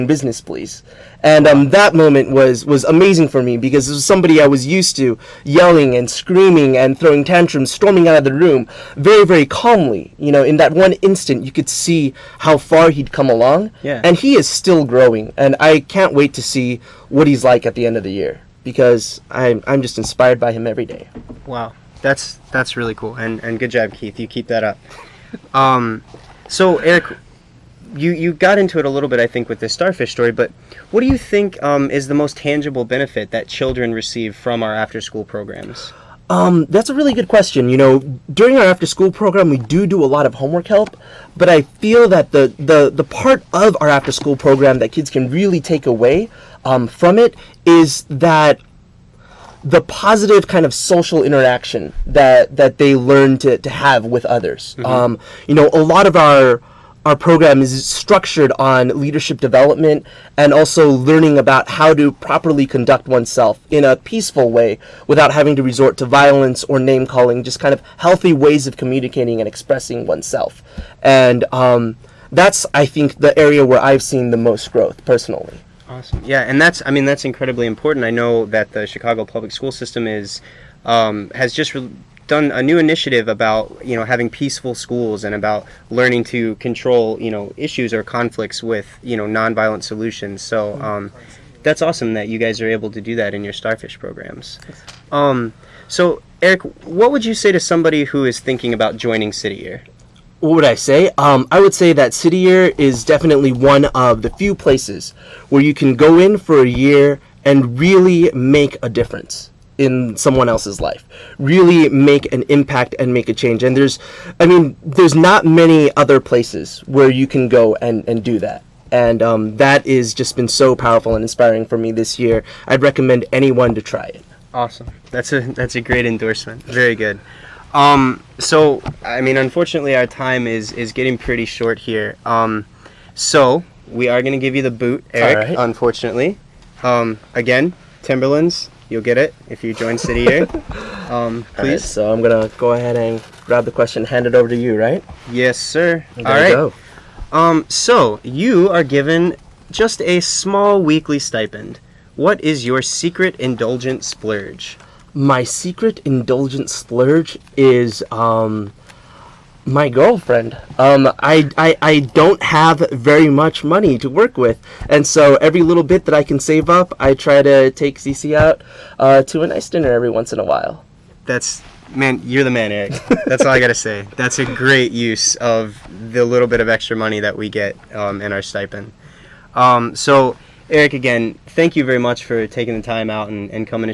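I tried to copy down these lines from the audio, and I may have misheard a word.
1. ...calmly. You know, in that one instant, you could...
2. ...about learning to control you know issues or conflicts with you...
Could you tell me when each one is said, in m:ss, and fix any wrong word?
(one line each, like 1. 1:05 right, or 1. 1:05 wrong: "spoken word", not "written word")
1. 0:09 right
2. 1:25 right.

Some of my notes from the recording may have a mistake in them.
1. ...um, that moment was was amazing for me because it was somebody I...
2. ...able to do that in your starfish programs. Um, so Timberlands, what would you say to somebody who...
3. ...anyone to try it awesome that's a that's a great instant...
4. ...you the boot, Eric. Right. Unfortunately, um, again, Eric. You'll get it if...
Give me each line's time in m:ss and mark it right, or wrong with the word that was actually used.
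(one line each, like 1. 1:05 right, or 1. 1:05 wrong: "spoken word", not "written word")
1. 0:01 right
2. 1:32 wrong: "Eric", not "Timberlands"
3. 2:03 wrong: "endorsement", not "instant"
4. 2:14 wrong: "Timberlands", not "Eric".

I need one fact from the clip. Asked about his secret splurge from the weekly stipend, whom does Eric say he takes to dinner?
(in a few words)
CC.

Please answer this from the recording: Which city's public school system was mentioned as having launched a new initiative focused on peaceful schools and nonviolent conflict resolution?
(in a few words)
Chicago.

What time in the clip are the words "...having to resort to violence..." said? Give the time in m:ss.
1:05.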